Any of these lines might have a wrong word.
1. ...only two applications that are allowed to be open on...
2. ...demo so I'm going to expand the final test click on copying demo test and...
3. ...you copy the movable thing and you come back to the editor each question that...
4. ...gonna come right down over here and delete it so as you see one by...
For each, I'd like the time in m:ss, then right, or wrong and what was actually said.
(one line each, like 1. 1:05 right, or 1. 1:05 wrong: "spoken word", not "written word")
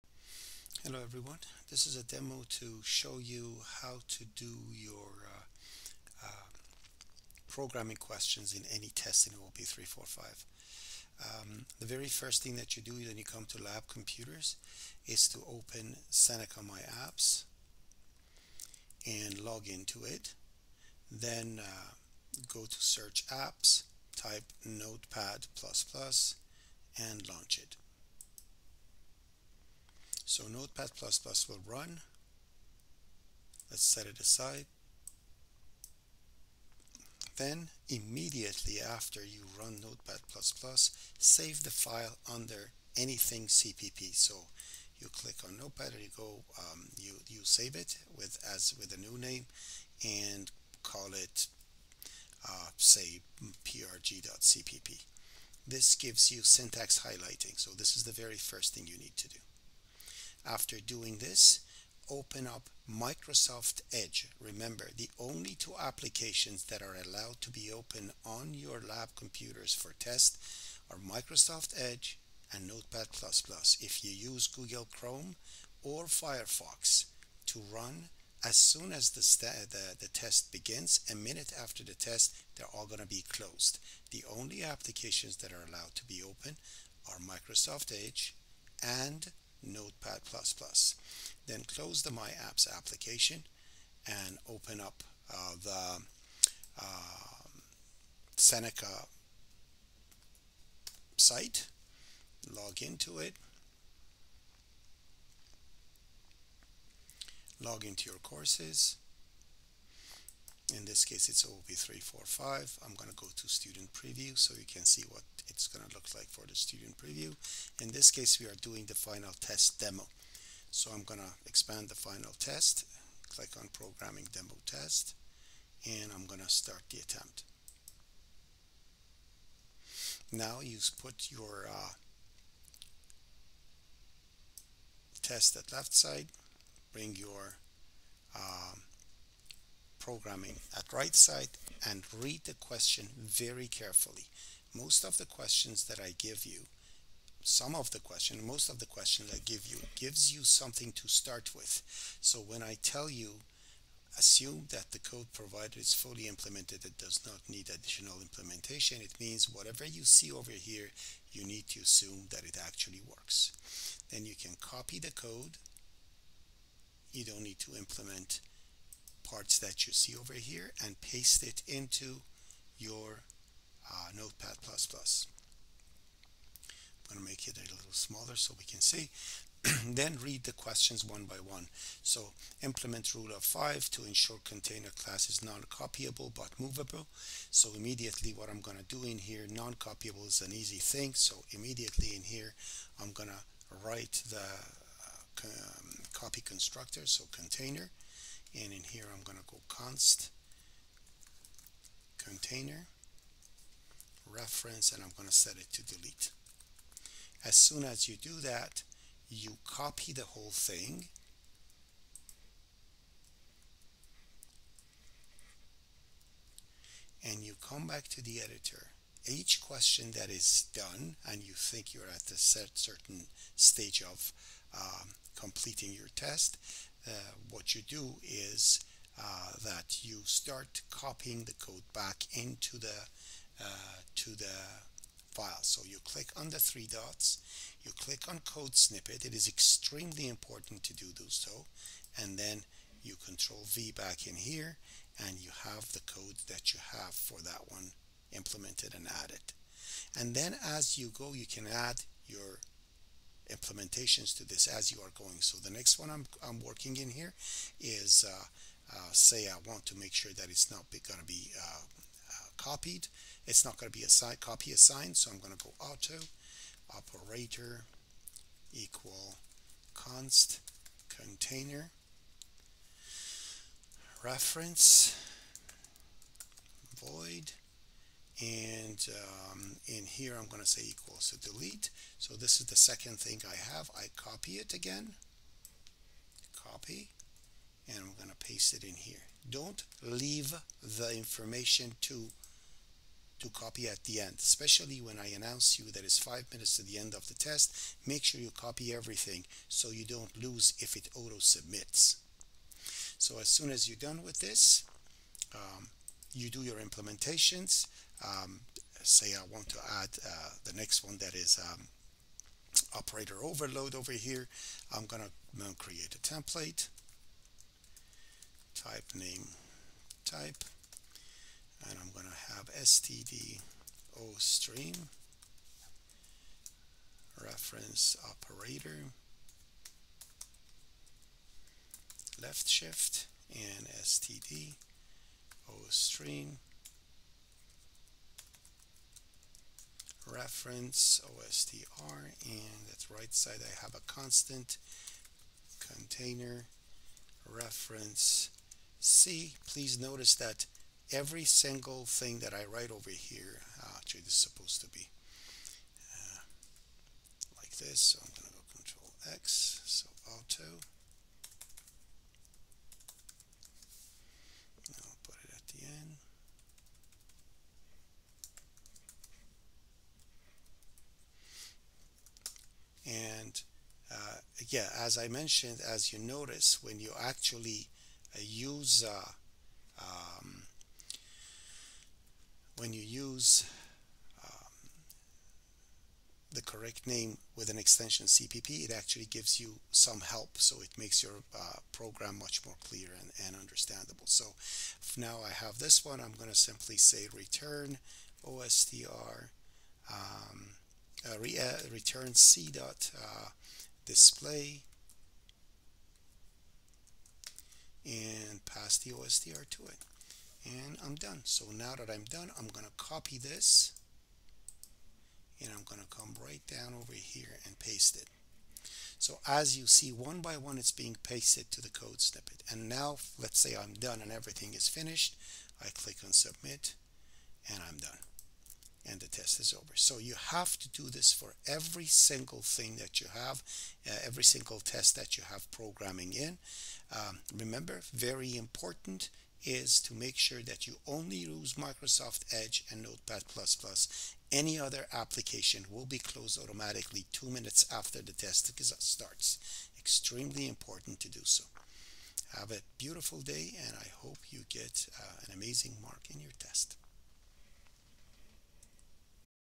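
1. 1:05 right
2. 1:59 wrong: "programming", not "copying"
3. 3:29 wrong: "whole", not "movable"
4. 6:55 wrong: "paste", not "delete".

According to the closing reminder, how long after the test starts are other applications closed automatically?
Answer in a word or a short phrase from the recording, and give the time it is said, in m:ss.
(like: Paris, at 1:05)
two minutes, at 7:27.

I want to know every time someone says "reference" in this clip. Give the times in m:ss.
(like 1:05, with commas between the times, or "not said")
3:24, 4:34, 5:27, 5:40, 5:47.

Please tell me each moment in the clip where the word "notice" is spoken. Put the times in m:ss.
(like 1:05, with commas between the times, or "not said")
5:49, 6:16.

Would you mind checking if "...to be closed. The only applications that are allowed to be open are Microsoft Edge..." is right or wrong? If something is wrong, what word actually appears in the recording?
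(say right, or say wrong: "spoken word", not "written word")
right.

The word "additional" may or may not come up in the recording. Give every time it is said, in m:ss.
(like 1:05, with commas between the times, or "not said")
2:37.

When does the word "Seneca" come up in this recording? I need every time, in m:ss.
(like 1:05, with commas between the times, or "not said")
0:16, 1:38.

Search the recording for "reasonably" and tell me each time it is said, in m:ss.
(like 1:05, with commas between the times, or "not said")
not said.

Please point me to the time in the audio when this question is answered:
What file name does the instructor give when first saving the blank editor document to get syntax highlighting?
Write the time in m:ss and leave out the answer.
0:53.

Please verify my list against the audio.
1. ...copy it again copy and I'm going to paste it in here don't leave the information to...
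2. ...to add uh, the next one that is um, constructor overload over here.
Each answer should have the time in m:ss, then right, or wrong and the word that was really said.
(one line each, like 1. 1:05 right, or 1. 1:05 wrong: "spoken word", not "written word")
1. 4:44 right
2. 5:09 wrong: "operator", not "constructor".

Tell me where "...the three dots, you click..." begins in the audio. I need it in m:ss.
3:56.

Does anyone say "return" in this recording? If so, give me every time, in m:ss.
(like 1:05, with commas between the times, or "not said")
6:37, 6:41.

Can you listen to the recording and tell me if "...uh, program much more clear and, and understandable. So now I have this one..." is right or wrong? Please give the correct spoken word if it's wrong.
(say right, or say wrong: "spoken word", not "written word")
right.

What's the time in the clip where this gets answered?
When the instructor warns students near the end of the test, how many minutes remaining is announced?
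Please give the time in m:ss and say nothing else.
4:56.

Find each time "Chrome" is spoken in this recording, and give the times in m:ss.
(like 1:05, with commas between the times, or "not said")
1:14.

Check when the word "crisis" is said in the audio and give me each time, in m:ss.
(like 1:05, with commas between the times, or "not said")
not said.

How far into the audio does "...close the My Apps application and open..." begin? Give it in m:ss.
1:31.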